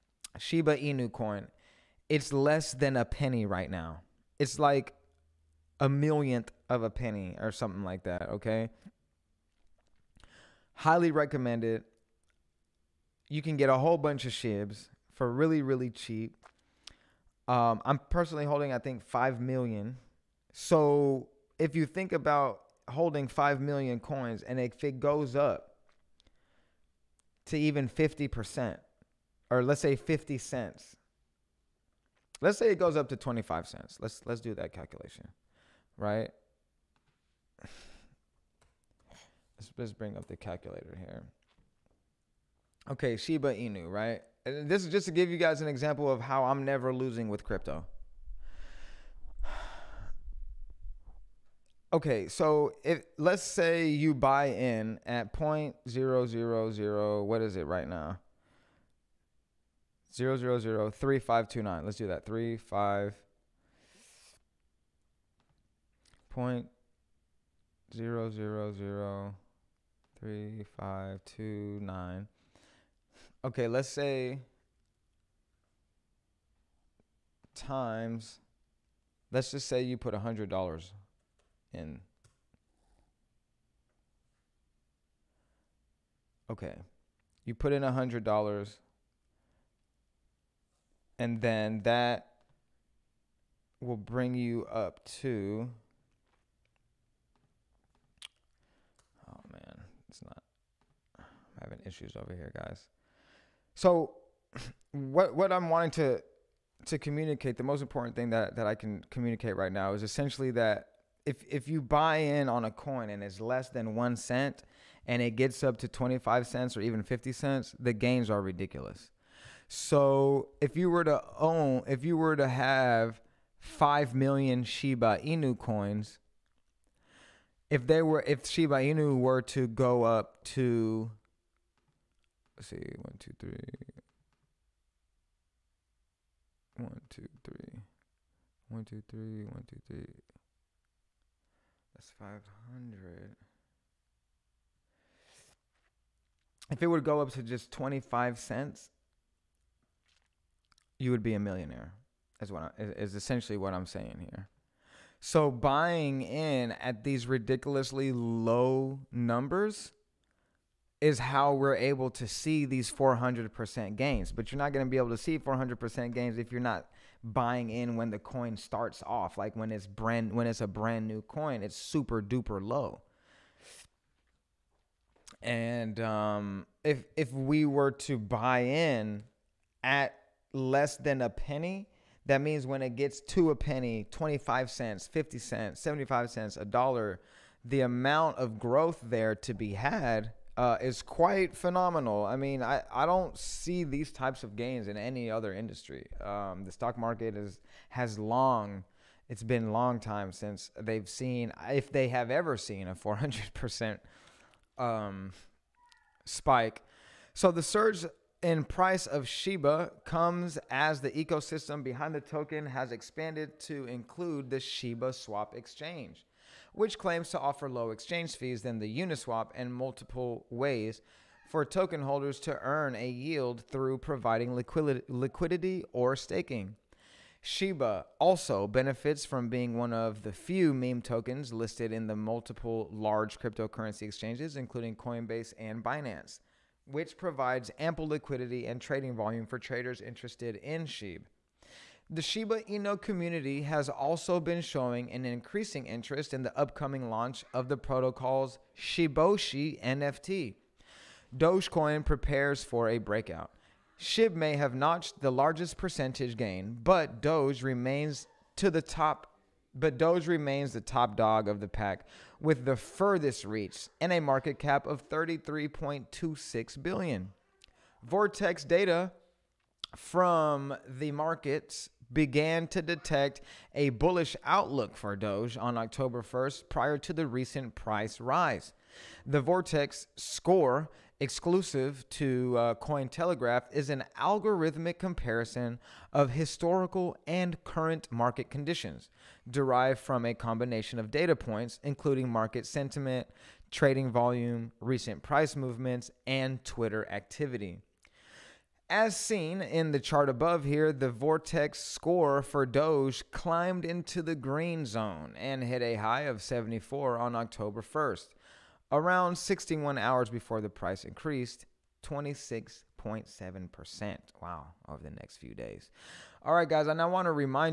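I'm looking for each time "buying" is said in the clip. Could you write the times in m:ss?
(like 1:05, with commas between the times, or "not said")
2:35, 2:47.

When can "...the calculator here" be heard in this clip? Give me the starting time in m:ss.
0:40.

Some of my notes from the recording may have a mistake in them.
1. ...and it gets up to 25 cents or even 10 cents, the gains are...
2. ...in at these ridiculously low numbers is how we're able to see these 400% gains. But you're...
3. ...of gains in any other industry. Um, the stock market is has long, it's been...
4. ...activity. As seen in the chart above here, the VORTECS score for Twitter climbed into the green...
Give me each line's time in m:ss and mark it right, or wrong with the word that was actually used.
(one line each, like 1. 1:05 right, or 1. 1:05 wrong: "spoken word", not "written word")
1. 1:55 wrong: "50", not "10"
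2. 2:36 right
3. 3:14 right
4. 4:57 wrong: "Doge", not "Twitter".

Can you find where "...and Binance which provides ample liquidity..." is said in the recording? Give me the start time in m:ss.
3:55.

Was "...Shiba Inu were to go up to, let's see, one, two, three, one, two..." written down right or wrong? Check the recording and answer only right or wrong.
right.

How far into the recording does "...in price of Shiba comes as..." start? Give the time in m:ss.
3:28.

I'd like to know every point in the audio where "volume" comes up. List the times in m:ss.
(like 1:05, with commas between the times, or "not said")
3:59, 4:54.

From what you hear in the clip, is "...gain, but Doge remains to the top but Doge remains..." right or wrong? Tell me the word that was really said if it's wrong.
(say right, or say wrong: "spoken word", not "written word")
right.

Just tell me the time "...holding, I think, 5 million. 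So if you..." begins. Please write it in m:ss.
0:18.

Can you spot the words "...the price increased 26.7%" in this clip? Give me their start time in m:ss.
5:10.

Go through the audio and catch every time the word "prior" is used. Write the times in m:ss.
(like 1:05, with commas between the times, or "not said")
4:36.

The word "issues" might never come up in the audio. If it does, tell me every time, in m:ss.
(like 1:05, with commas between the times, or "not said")
1:41.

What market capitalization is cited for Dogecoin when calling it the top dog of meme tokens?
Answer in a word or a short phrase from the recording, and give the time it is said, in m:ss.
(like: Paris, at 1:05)
33.26 billion, at 4:25.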